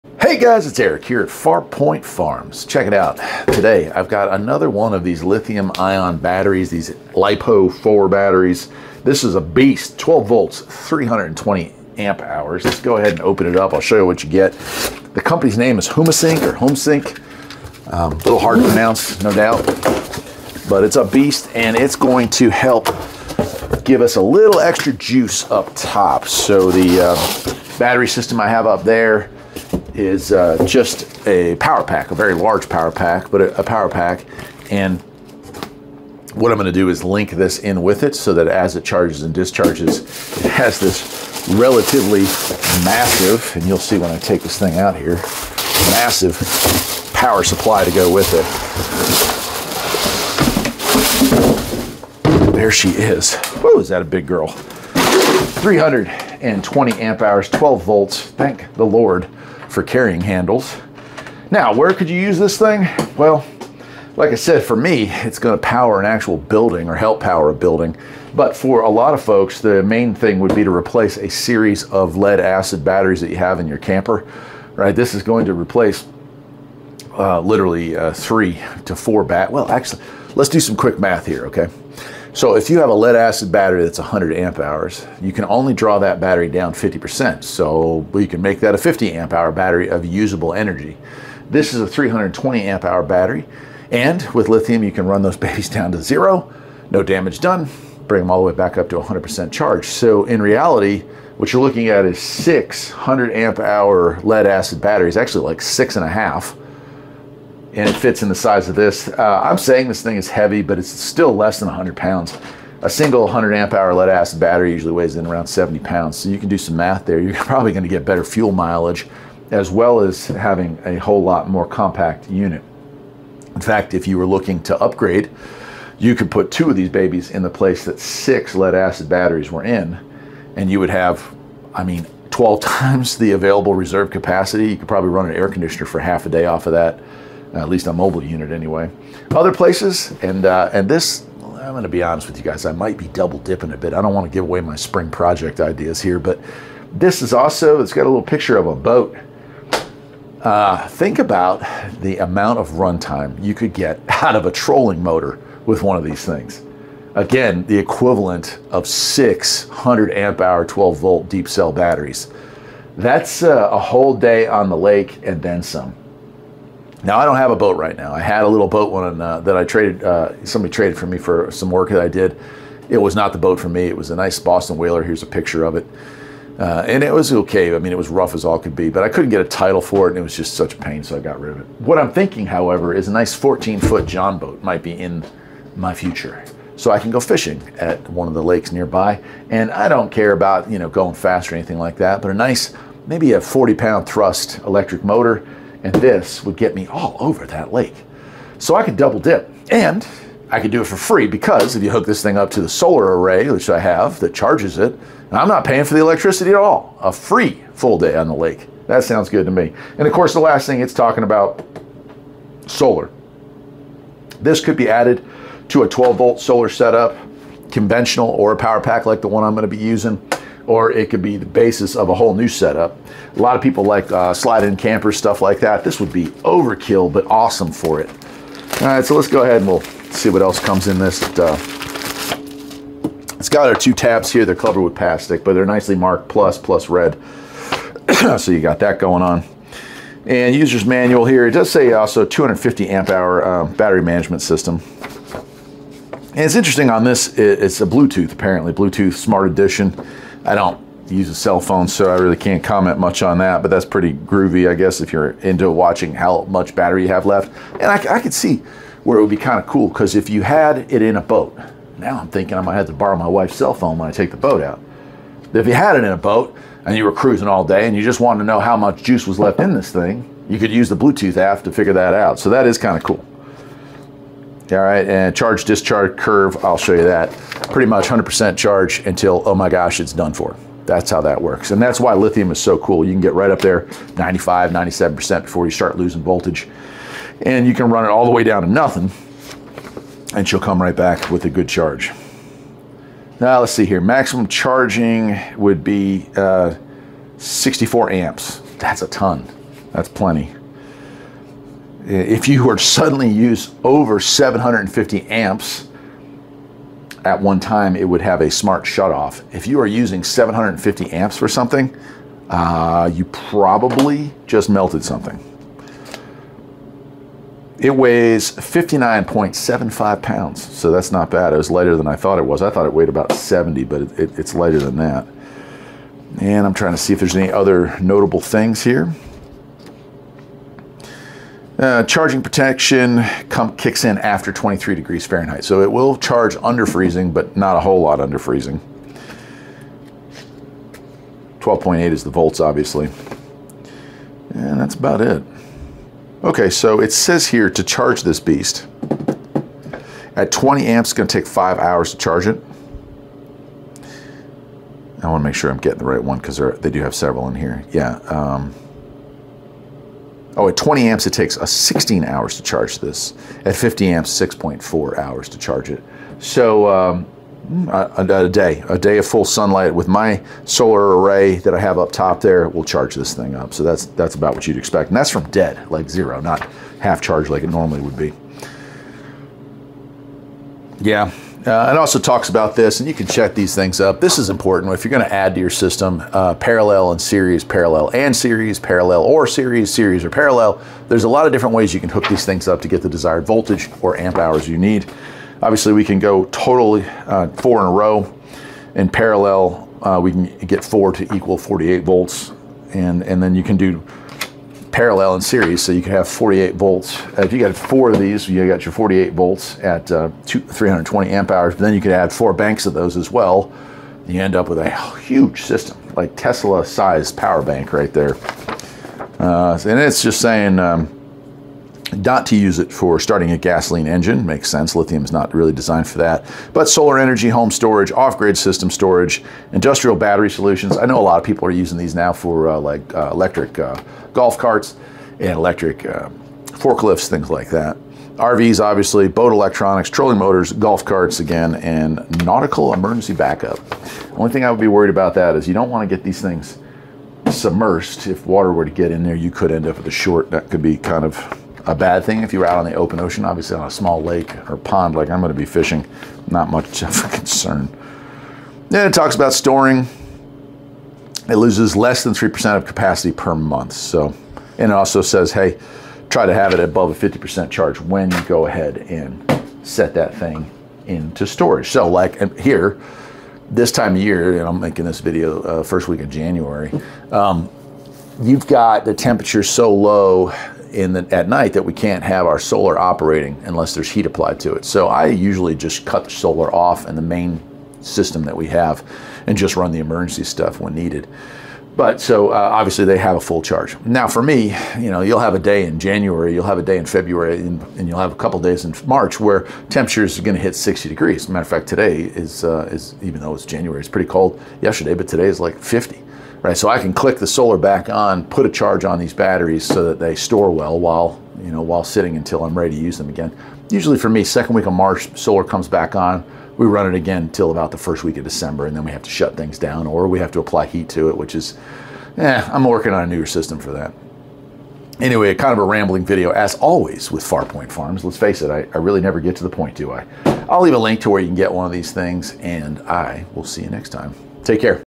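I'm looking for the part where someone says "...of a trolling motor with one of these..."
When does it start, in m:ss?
2:34.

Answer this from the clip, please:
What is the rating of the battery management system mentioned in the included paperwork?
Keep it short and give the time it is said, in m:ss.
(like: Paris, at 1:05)
250 amp hour, at 4:02.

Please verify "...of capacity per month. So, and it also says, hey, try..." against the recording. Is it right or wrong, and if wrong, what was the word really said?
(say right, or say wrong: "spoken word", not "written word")
right.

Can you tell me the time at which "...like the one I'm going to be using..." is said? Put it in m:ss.
3:39.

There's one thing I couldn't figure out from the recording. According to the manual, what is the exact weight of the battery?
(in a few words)
59.75 pounds.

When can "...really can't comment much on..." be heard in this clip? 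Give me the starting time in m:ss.
4:12.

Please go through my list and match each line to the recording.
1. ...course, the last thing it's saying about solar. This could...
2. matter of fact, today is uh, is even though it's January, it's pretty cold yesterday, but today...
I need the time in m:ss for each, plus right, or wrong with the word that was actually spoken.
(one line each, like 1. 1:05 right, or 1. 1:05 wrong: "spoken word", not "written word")
1. 3:30 wrong: "talking", not "saying"
2. 8:21 right.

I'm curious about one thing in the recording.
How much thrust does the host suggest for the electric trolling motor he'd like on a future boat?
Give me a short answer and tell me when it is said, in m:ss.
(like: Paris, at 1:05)
40-pound, at 3:13.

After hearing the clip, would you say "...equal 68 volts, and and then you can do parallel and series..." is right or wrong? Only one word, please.
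wrong.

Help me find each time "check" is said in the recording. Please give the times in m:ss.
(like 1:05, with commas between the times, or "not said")
0:02, 6:23.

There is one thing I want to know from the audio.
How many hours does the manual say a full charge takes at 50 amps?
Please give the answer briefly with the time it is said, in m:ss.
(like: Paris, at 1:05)
6.4 hours, at 6:04.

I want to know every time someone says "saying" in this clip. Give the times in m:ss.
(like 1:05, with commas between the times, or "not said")
1:49, 7:00.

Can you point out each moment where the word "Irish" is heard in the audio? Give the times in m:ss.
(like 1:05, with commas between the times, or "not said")
not said.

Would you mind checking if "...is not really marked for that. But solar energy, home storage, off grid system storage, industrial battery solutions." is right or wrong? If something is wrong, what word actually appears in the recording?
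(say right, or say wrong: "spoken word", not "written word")
wrong: "designed", not "marked".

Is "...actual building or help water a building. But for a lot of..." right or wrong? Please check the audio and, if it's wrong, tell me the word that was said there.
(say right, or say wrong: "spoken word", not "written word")
wrong: "power", not "water".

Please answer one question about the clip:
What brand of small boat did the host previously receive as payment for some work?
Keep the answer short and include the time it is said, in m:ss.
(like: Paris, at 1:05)
Boston Whaler, at 2:54.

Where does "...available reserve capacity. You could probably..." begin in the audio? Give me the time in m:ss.
2:13.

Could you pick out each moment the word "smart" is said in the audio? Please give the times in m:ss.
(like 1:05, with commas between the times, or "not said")
4:09, 5:08.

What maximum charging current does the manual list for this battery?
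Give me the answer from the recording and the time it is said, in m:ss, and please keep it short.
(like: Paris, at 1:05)
64 amps, at 4:57.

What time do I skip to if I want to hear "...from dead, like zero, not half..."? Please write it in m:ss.
6:15.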